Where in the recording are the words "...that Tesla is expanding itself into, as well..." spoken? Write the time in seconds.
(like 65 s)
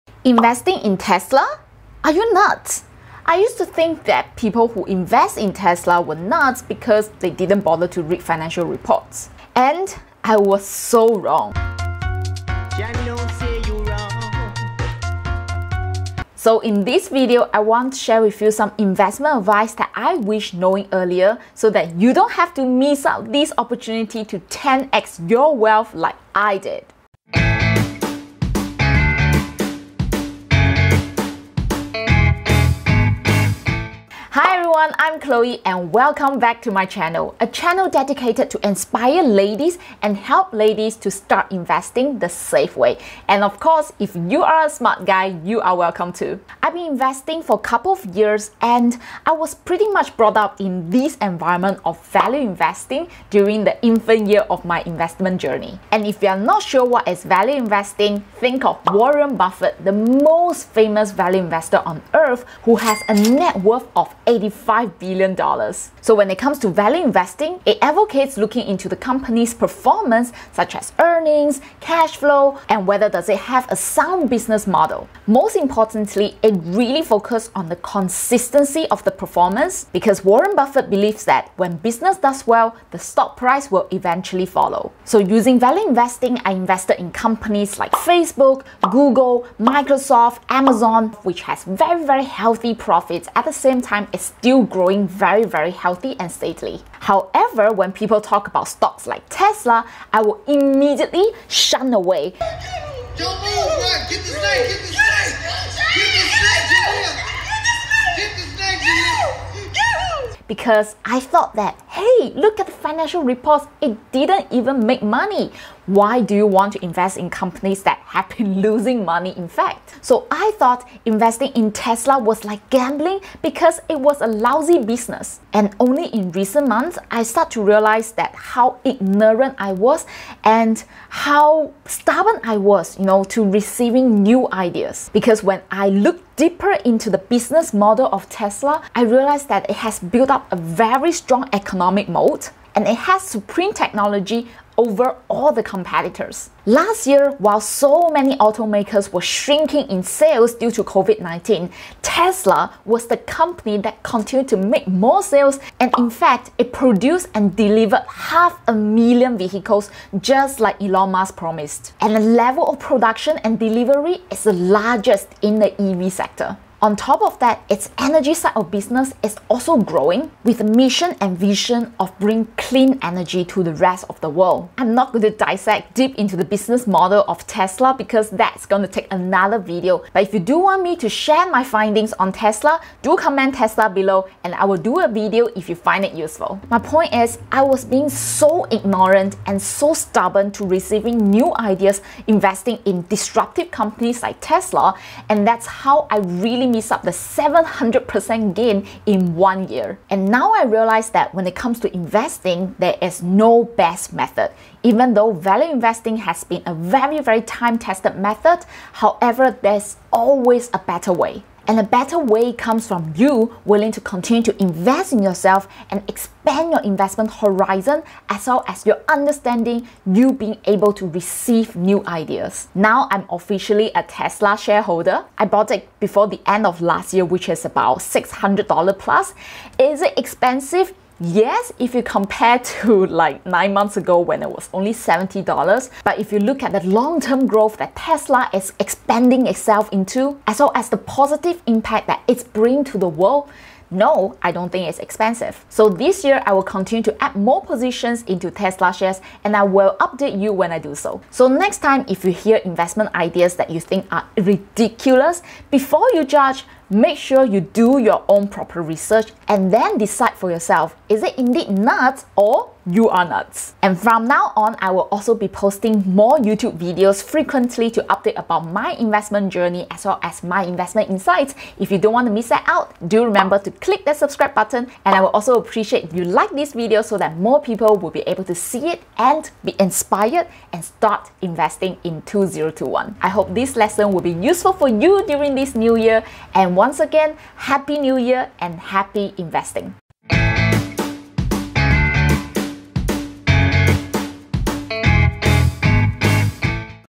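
237 s.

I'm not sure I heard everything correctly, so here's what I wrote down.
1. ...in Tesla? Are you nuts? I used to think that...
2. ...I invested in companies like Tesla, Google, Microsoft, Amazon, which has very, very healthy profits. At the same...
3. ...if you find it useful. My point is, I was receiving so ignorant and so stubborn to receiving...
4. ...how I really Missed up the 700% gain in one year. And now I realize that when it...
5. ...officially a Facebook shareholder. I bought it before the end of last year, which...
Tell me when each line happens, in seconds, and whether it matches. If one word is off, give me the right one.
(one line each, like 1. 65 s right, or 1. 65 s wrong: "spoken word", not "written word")
1. 0 s right
2. 86 s wrong: "Facebook", not "Tesla"
3. 185 s wrong: "being", not "receiving"
4. 195 s right
5. 223 s wrong: "Tesla", not "Facebook".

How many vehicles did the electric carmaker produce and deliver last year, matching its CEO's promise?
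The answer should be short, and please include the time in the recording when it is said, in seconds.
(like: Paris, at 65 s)
half a million, at 158 s.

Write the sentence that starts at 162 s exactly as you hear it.
And the level of production and delivery is the largest in the EV sector.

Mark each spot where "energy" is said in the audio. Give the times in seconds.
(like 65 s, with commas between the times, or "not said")
167 s, 173 s.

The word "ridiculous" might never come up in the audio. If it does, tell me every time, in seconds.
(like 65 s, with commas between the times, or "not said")
254 s.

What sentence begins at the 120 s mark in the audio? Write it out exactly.
So I thought investing in Tesla was like gambling because it was a lousy business.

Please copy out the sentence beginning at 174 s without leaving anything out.
I'm not going to dissect deep into the business model of Tesla because that's going to take another video.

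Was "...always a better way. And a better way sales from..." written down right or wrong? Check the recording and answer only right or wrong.
wrong.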